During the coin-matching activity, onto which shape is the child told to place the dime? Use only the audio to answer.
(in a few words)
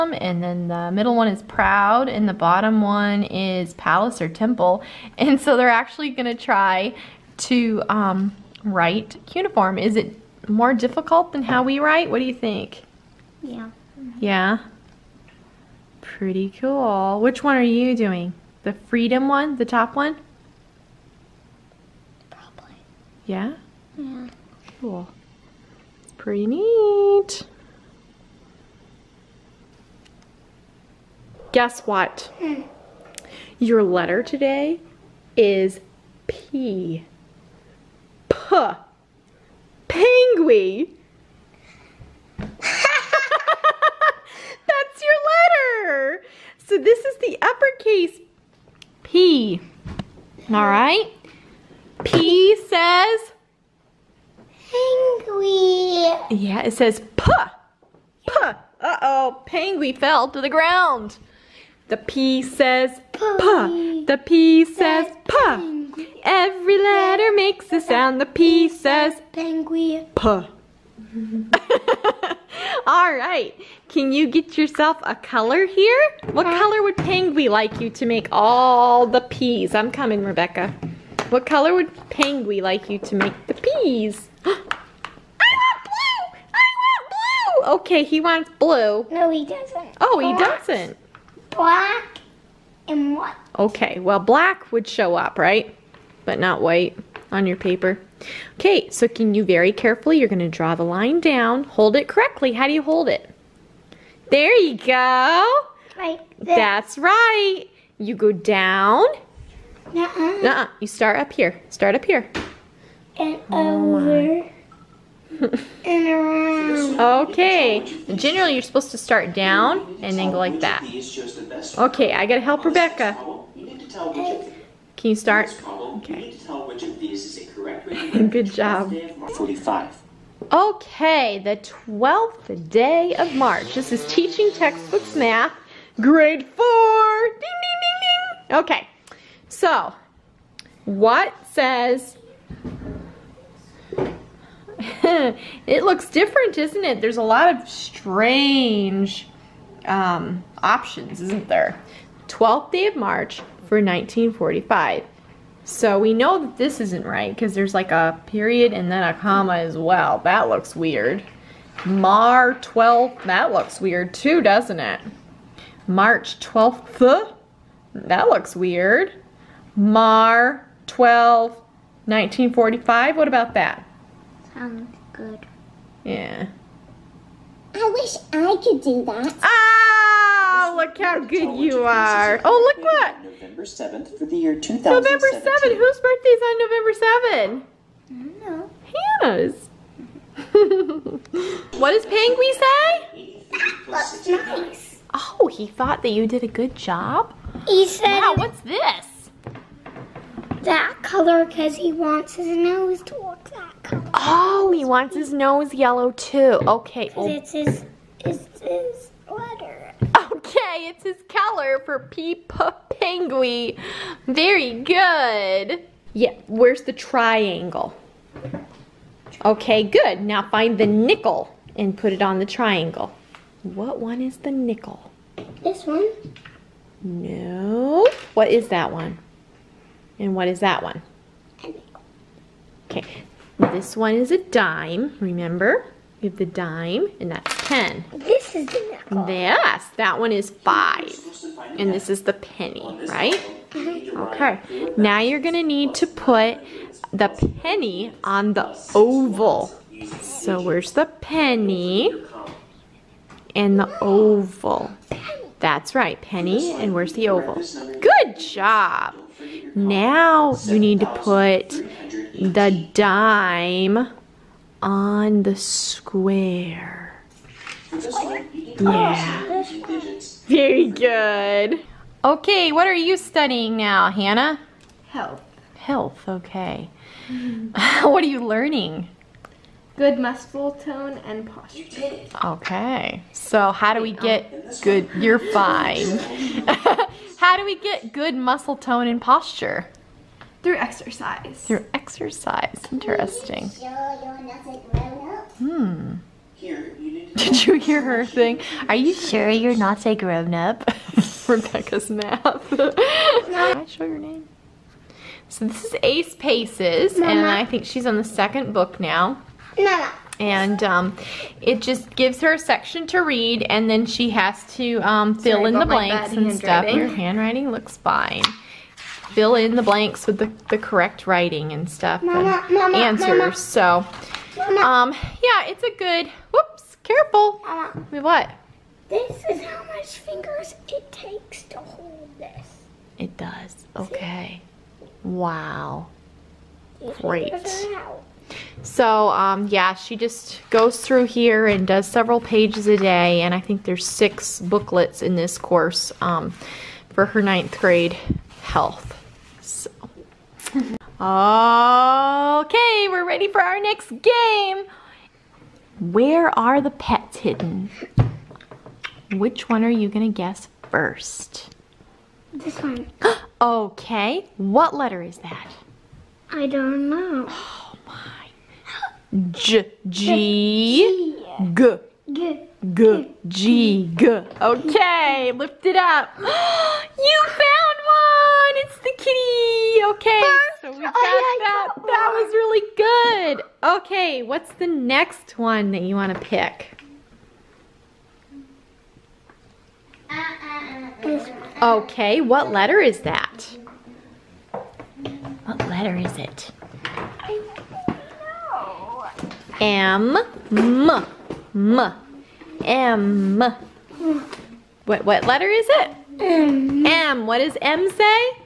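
square.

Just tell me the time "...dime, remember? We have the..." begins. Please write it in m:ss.
3:54.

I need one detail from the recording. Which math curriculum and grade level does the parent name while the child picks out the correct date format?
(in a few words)
Teaching Textbooks Math, grade 4.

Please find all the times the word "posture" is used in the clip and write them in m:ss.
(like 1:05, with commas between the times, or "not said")
4:41, 4:49.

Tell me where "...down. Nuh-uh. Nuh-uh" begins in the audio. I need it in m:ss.
1:48.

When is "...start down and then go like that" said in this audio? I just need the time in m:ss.
1:58.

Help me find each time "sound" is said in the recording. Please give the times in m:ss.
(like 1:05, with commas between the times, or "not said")
1:07, 2:54.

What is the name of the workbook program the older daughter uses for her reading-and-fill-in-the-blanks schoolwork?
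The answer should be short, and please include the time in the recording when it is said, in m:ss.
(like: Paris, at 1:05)
Ace Paces, at 5:06.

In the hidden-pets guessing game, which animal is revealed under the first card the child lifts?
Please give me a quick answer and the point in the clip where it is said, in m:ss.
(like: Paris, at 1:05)
kitty, at 6:18.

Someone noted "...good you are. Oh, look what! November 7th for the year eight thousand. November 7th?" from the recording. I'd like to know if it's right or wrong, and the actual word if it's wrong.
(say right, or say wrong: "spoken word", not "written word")
wrong: "two", not "eight".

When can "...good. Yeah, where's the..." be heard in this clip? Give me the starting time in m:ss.
3:34.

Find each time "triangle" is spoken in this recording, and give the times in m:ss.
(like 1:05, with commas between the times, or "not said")
3:36, 3:42.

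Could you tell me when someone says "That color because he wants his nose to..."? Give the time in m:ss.
3:20.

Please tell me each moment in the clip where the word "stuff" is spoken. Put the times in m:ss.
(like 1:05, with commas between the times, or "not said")
5:16, 5:21.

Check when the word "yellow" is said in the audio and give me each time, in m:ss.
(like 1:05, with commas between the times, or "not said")
3:25.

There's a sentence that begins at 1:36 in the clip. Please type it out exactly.
But not white on your paper.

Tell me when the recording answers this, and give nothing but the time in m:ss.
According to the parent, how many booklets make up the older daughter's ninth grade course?
5:44.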